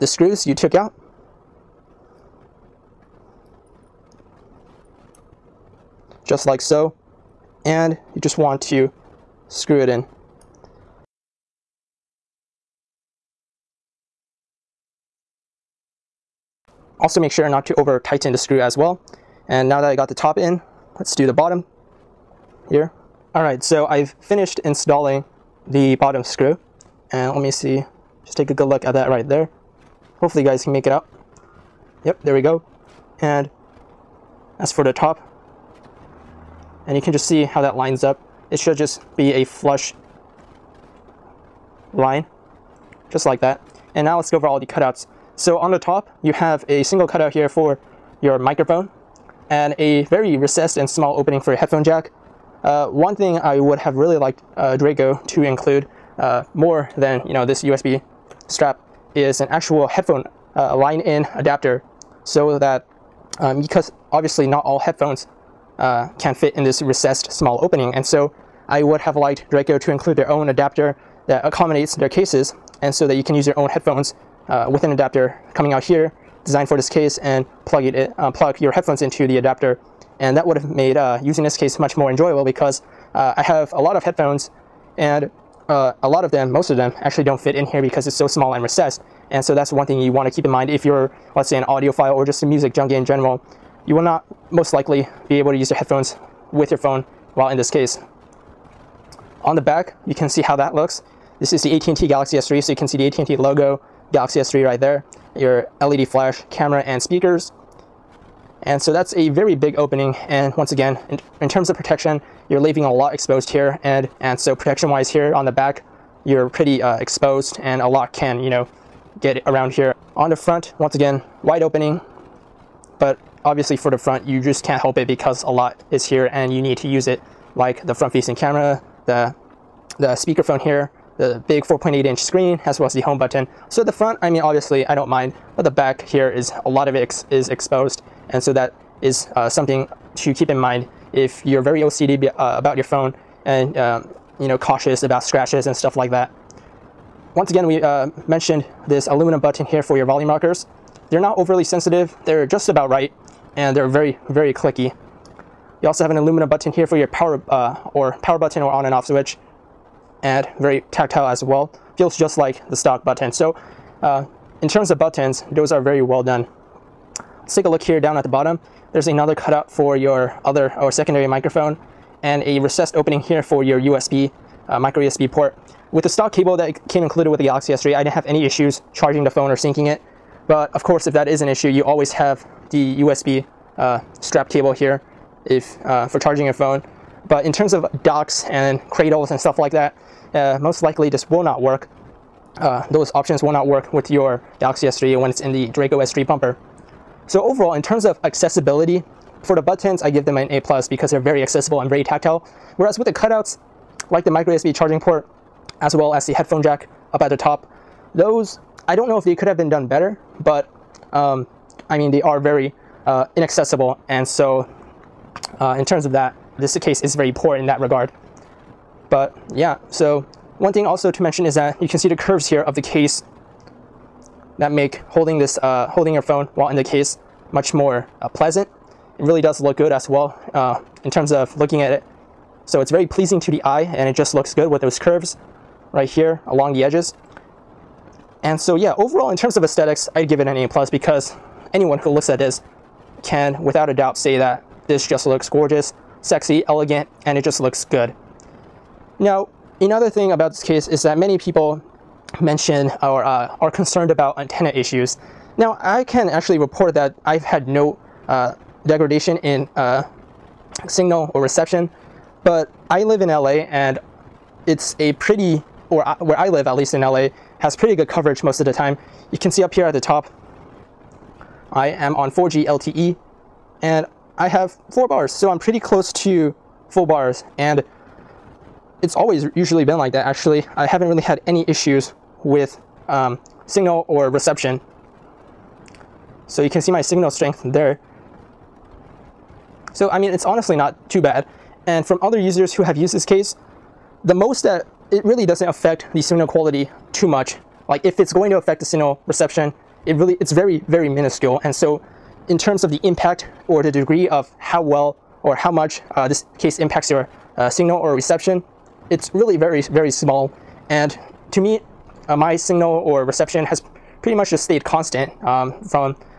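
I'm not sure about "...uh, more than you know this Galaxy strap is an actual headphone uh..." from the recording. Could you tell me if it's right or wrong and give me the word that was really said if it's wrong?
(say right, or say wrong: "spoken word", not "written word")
wrong: "USB", not "Galaxy".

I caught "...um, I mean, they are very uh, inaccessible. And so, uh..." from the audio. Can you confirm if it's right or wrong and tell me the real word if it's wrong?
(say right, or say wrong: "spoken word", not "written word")
right.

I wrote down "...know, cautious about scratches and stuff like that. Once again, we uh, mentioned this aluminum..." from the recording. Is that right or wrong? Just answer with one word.
right.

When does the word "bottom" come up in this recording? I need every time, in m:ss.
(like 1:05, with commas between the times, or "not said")
0:21, 0:25, 2:48.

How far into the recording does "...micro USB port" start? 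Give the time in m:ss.
2:54.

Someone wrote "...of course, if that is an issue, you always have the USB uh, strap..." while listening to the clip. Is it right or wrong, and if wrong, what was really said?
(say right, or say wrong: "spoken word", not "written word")
right.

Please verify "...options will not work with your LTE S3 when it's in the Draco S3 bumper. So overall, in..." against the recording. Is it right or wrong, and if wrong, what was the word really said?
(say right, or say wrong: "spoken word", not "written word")
wrong: "Galaxy", not "LTE".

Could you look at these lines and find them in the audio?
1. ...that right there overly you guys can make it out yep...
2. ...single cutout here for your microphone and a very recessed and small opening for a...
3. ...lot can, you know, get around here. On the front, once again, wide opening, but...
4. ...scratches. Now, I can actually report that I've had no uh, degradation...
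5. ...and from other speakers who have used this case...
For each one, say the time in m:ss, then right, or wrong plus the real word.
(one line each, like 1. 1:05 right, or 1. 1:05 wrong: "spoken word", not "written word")
1. 0:28 wrong: "hopefully", not "overly"
2. 0:46 right
3. 1:57 right
4. 4:14 wrong: "issues", not "scratches"
5. 4:51 wrong: "users", not "speakers".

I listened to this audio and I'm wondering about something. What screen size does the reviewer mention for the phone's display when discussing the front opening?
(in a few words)
4.8 inch.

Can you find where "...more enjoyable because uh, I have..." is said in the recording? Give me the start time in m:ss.
1:21.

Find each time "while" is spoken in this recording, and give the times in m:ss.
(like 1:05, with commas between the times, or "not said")
1:37, 3:46.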